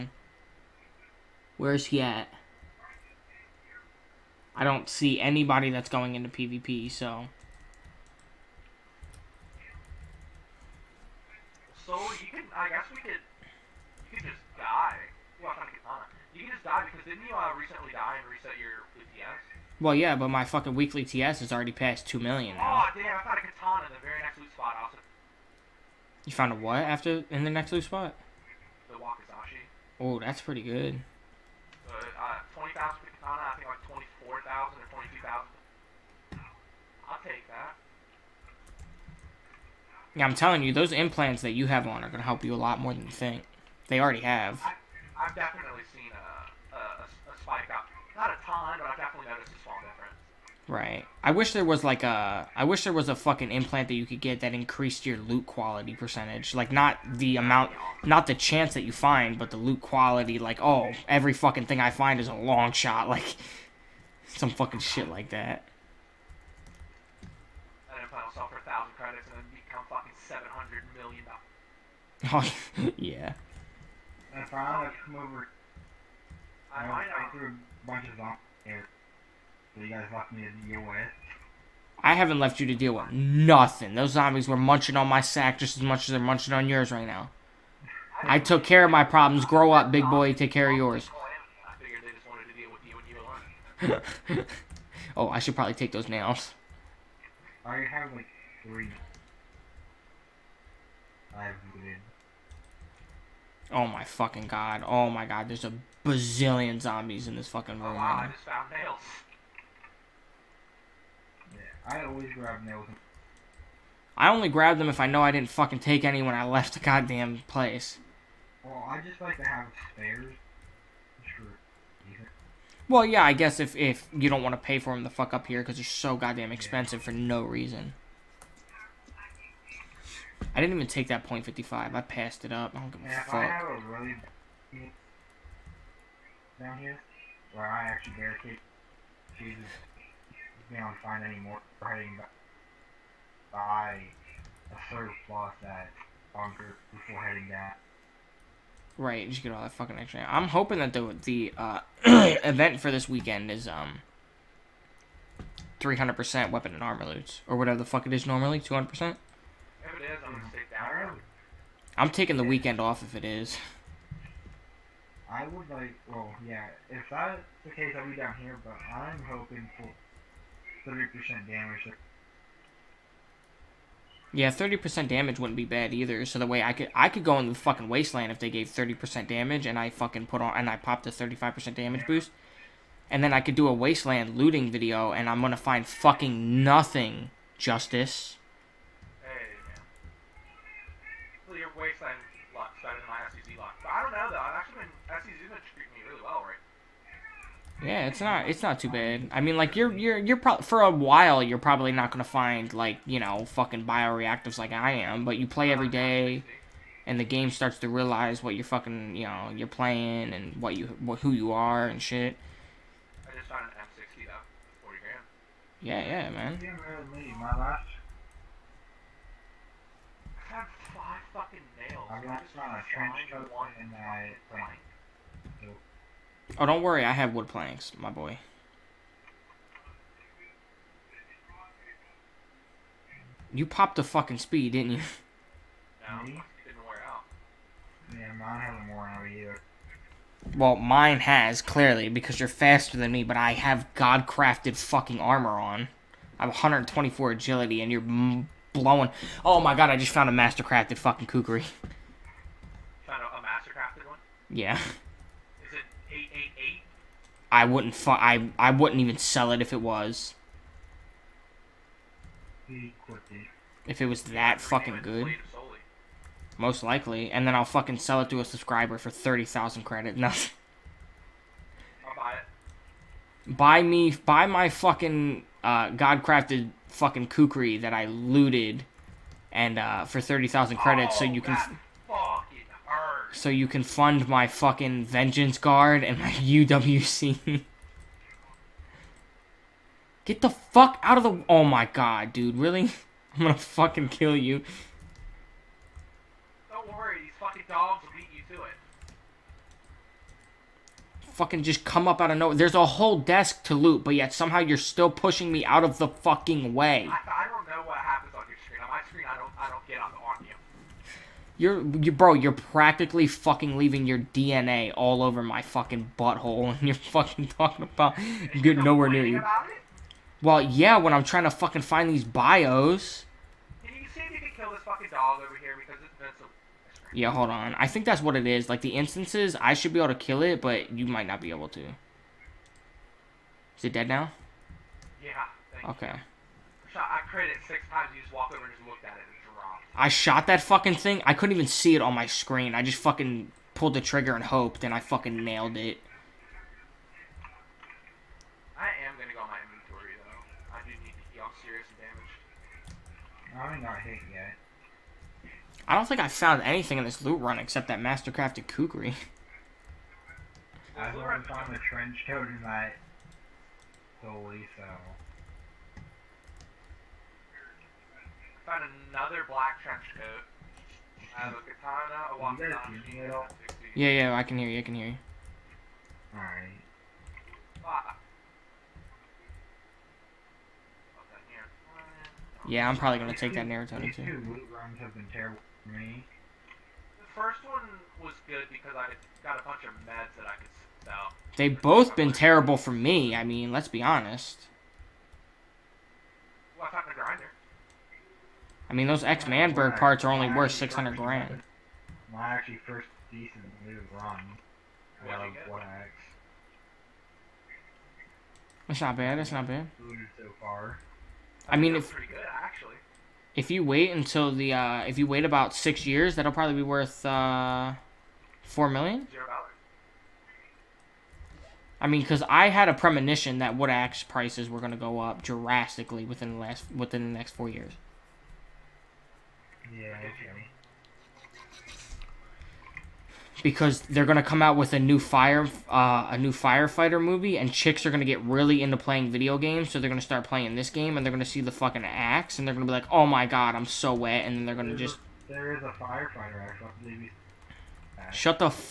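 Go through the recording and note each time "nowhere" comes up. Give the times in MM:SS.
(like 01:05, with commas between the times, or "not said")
05:02, 05:18.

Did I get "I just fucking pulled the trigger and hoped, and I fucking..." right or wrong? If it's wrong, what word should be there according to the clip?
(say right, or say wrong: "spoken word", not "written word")
right.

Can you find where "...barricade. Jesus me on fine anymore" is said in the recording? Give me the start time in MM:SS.
02:18.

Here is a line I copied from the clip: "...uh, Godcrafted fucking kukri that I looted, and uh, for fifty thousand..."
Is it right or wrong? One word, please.
wrong.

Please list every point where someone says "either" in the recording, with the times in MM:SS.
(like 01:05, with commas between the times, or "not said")
02:55, 03:59.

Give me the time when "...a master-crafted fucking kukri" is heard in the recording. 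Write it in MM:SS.
04:10.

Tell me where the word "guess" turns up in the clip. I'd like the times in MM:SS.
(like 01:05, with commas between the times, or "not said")
00:12, 02:03.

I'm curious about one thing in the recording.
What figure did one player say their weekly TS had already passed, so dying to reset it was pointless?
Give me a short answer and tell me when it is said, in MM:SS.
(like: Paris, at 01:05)
2 million, at 00:22.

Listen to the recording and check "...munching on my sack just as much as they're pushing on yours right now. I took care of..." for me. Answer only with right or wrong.
wrong.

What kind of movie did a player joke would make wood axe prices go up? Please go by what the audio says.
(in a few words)
firefighter movie.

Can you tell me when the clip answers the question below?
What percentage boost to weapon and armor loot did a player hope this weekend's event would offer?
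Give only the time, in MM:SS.
02:35.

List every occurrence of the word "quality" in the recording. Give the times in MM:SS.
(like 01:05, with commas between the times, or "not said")
00:55, 00:59.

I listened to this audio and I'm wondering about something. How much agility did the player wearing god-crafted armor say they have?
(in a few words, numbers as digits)
124.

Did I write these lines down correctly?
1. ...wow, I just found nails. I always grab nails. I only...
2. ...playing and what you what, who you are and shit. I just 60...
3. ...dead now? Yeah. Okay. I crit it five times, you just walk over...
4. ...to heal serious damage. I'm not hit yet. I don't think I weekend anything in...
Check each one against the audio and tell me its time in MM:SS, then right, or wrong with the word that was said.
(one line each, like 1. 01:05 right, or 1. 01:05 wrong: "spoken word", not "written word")
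1. 01:47 right
2. 03:29 right
3. 05:33 wrong: "six", not "five"
4. 05:51 wrong: "found", not "weekend".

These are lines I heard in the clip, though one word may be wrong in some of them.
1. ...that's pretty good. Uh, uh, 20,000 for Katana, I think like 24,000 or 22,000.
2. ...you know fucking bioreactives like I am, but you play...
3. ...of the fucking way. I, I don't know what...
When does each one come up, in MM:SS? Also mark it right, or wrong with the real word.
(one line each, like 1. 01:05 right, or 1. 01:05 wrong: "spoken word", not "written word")
1. 00:30 right
2. 03:23 right
3. 05:05 right.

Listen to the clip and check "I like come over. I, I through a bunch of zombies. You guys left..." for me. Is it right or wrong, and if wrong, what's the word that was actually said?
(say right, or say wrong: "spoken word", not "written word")
right.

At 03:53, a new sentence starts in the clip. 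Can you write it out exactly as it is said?
You popped the fucking speed, didn't you?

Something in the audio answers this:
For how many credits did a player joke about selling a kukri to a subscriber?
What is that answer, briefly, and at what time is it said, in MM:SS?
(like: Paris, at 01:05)
30,000, at 04:29.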